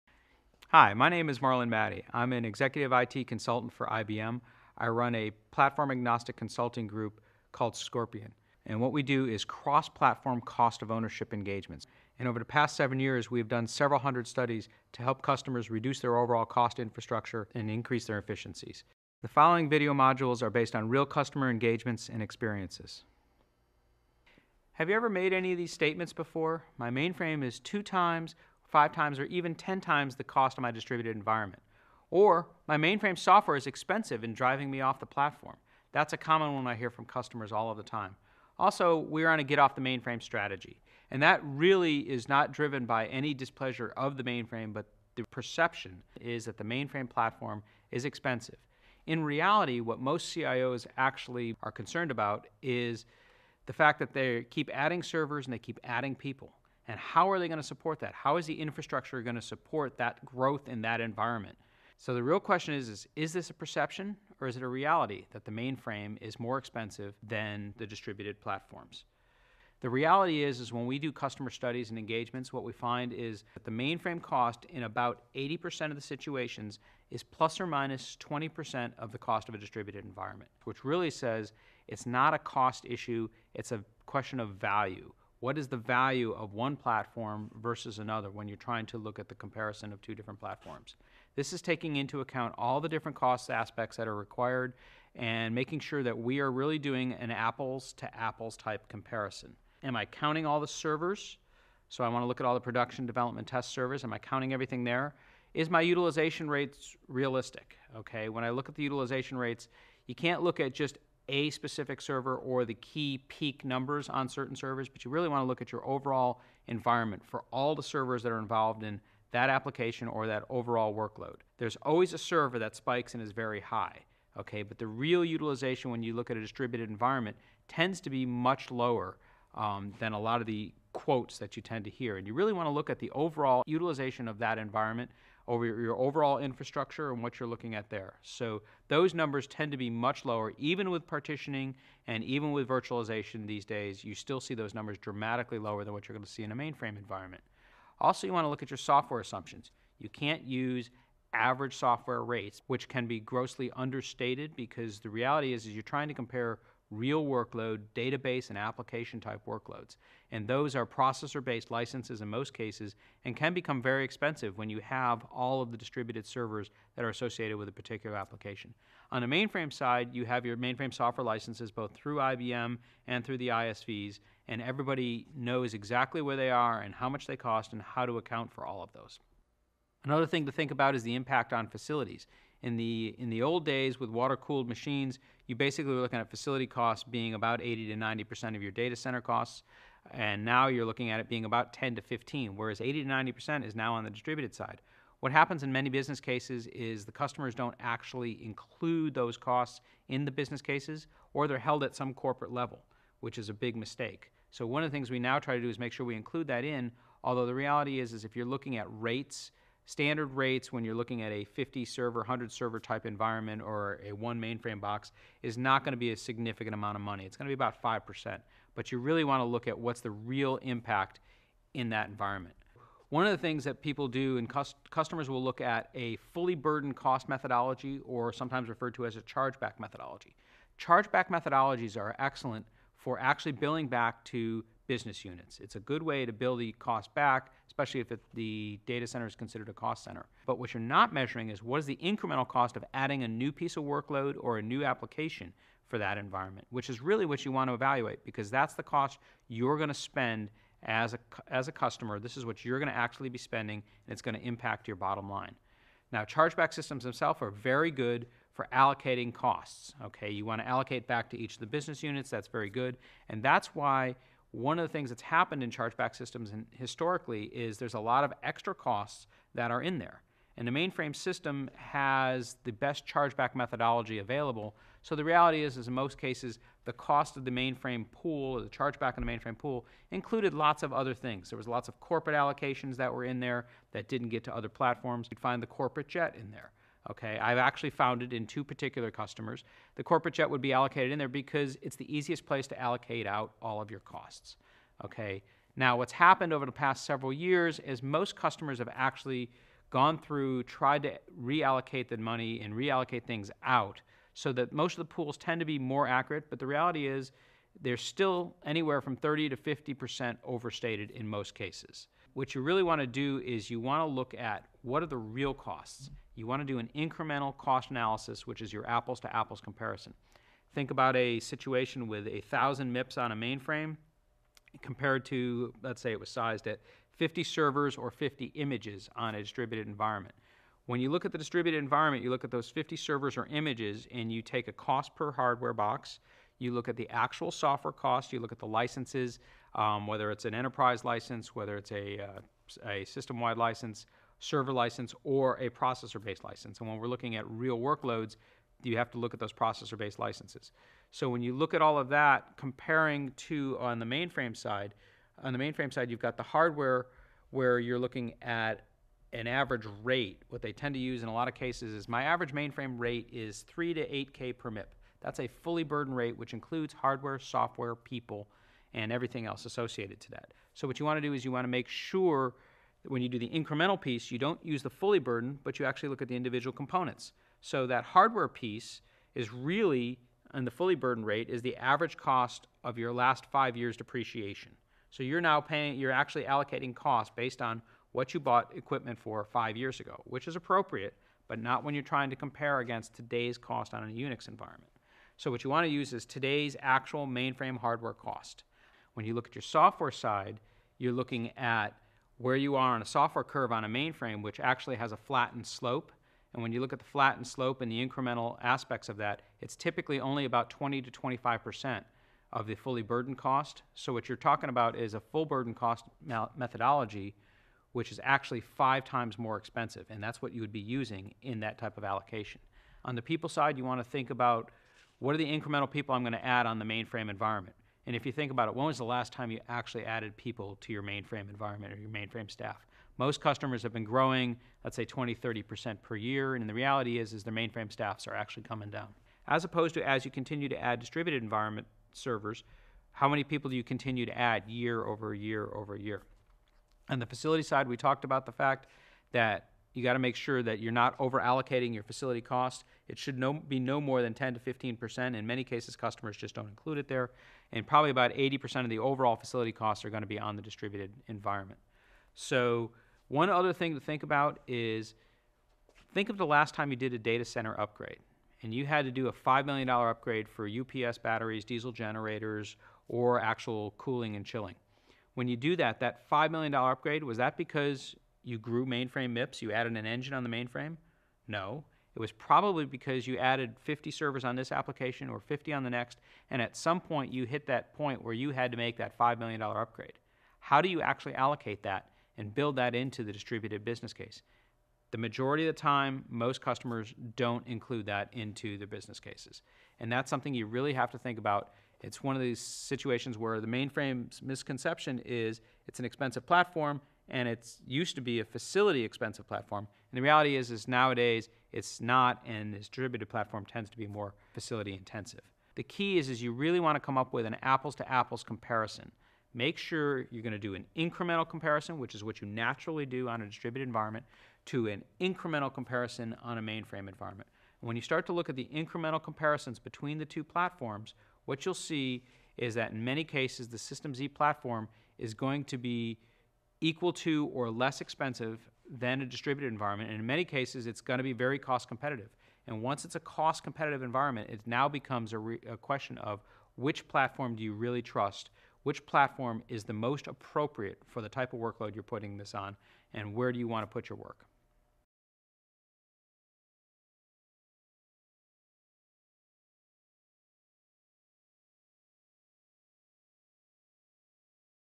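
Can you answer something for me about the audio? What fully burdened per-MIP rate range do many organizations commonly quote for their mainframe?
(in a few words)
3 to 8K per MIP.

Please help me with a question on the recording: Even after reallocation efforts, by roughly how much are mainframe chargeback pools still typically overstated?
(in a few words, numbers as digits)
30 to 50%.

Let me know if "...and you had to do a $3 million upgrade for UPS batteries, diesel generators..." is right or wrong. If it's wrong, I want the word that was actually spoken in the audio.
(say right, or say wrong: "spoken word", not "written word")
wrong: "5", not "3".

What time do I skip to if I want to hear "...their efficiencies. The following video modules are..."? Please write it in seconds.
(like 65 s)
18 s.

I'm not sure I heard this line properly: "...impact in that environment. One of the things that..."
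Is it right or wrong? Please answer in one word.
right.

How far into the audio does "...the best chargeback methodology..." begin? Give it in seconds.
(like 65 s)
272 s.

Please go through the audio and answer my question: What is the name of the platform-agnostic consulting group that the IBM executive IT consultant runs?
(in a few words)
Scorpion.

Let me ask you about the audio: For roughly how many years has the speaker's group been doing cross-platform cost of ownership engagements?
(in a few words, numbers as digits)
7.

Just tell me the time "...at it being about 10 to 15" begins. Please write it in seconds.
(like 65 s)
191 s.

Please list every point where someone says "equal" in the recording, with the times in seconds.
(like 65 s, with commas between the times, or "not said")
536 s.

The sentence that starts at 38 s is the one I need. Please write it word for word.
Also, we're on a get off the mainframe strategy.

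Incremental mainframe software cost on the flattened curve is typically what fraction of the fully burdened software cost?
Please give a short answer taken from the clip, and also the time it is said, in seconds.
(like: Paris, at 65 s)
20 to 25%, at 410 s.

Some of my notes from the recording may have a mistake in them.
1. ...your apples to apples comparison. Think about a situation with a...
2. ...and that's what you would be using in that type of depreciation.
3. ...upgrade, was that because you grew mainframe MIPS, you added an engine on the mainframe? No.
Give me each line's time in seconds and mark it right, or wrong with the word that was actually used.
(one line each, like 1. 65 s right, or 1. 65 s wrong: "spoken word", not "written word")
1. 318 s right
2. 420 s wrong: "allocation", not "depreciation"
3. 476 s right.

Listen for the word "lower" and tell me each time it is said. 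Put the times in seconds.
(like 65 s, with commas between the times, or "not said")
128 s, 140 s, 145 s.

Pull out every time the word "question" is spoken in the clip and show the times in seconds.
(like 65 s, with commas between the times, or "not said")
62 s, 84 s, 545 s.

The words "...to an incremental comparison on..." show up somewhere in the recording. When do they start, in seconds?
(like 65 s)
524 s.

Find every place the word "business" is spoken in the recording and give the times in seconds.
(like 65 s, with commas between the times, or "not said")
195 s, 200 s, 234 s, 261 s, 493 s, 498 s.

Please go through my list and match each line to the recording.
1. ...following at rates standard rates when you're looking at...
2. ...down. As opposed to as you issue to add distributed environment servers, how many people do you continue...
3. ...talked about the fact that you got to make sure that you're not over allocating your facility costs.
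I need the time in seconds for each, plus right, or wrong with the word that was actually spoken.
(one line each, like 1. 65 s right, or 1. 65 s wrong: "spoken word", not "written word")
1. 208 s wrong: "looking", not "following"
2. 438 s wrong: "continue", not "issue"
3. 447 s right.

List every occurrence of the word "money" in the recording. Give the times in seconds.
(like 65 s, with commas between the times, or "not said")
217 s, 302 s.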